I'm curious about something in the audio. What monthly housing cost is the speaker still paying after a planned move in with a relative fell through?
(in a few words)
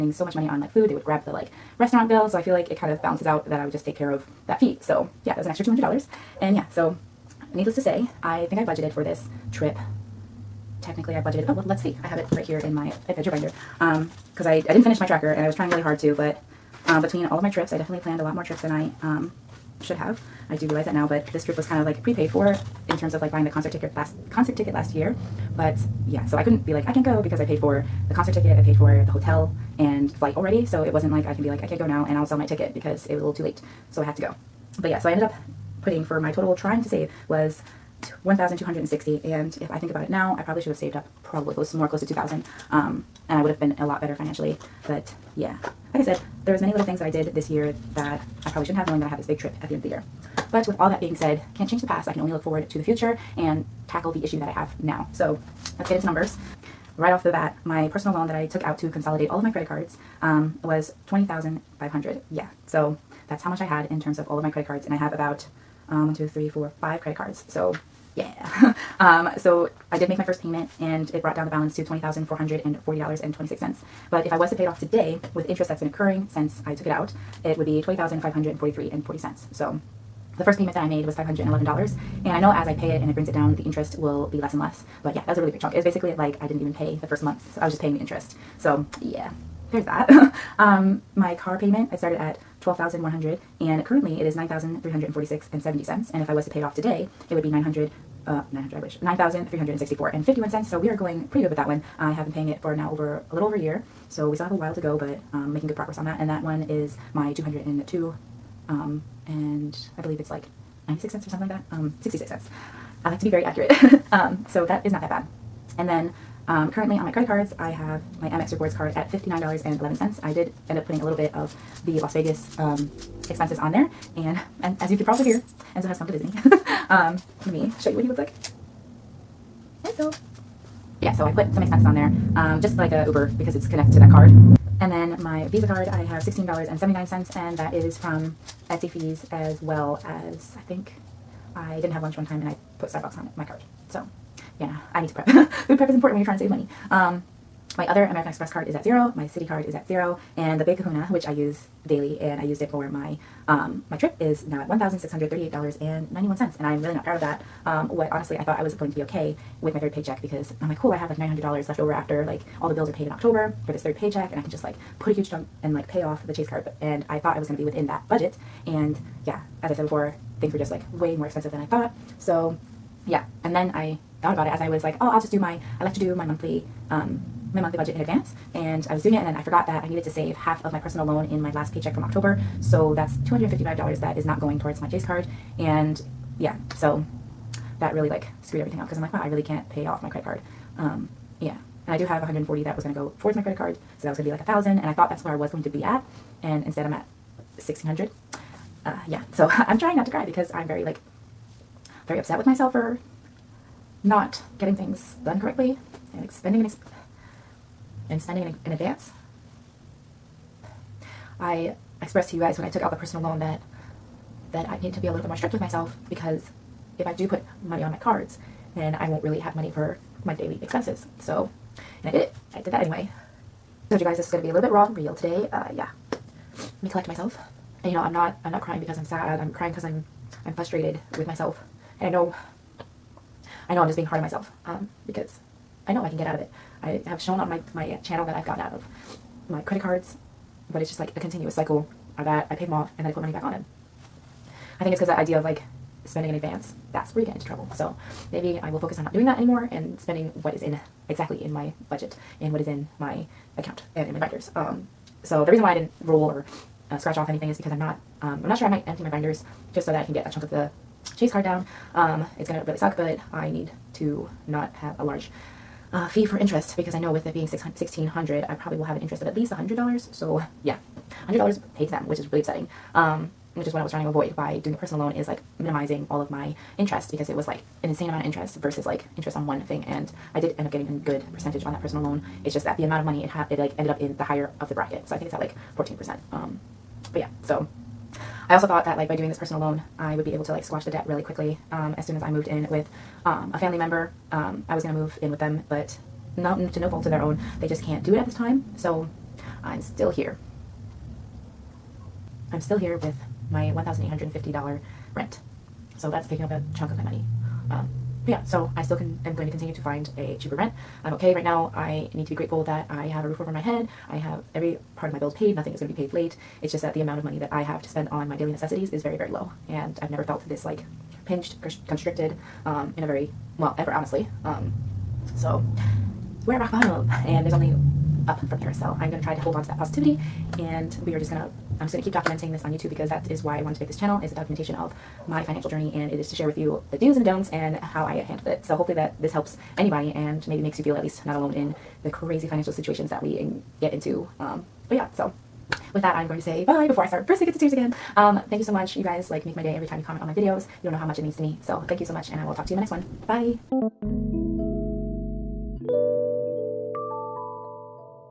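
$1,850.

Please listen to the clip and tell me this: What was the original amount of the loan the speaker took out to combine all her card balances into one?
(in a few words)
$20,500.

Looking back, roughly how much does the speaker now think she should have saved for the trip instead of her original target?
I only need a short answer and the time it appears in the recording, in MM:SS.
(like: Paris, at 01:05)
2000, at 00:41.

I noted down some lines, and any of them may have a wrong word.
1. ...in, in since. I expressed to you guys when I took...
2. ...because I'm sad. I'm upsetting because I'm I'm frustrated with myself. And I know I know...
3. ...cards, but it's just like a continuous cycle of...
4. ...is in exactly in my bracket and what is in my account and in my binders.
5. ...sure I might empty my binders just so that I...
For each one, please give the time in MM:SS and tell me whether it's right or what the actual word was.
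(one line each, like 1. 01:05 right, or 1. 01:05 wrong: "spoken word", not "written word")
1. 03:28 wrong: "advance", not "since"
2. 03:48 wrong: "crying", not "upsetting"
3. 03:59 right
4. 04:10 wrong: "budget", not "bracket"
5. 04:18 right.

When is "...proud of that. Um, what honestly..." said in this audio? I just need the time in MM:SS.
02:37.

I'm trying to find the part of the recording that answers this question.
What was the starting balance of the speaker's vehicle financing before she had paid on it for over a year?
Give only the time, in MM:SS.
01:32.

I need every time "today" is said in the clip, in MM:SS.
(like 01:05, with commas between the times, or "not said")
01:14, 01:36, 03:45.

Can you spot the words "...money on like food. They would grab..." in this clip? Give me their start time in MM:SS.
00:00.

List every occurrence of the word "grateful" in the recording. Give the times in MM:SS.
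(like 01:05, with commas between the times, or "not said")
05:12.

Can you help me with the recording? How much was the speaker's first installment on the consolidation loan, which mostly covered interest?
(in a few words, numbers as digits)
$511.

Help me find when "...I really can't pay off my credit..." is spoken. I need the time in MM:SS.
03:09.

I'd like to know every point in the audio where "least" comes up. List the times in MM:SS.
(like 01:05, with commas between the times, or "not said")
04:29, 05:41.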